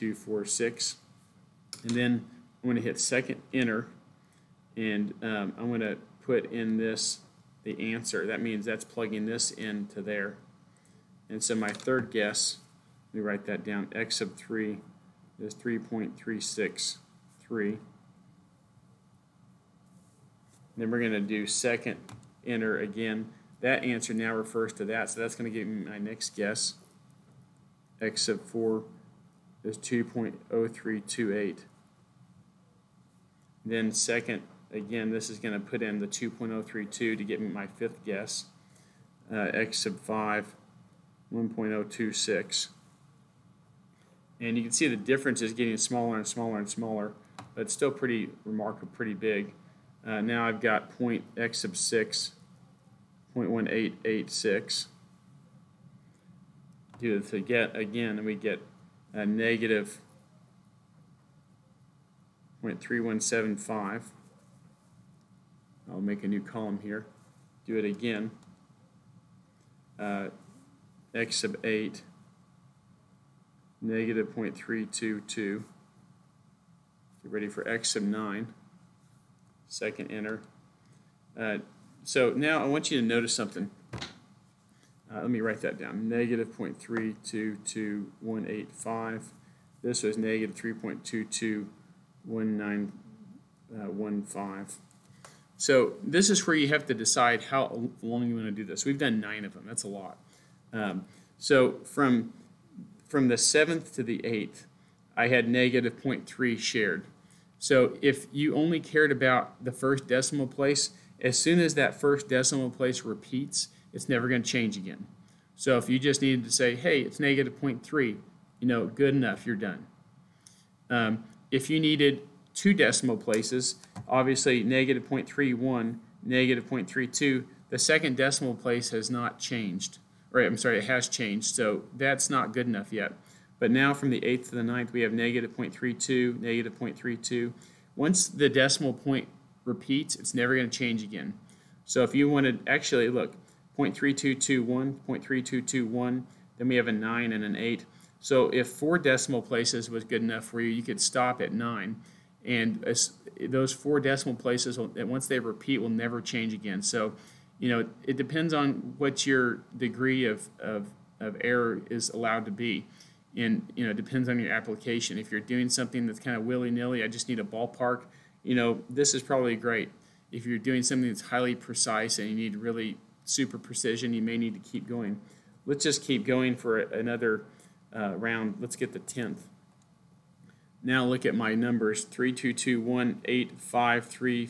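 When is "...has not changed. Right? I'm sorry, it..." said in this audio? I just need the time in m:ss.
2:08.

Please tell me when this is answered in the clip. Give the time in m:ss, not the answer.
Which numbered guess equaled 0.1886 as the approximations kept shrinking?
0:51.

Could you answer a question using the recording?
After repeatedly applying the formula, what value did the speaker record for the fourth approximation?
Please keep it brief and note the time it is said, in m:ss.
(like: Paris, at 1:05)
2.0328, at 0:29.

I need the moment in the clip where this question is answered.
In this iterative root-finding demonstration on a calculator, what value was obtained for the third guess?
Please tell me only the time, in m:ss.
0:15.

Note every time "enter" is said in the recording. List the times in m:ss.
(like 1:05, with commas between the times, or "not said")
0:03, 0:22, 1:20.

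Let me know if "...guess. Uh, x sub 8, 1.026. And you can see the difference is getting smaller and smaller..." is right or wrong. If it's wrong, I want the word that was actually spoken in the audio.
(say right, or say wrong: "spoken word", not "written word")
wrong: "5", not "8".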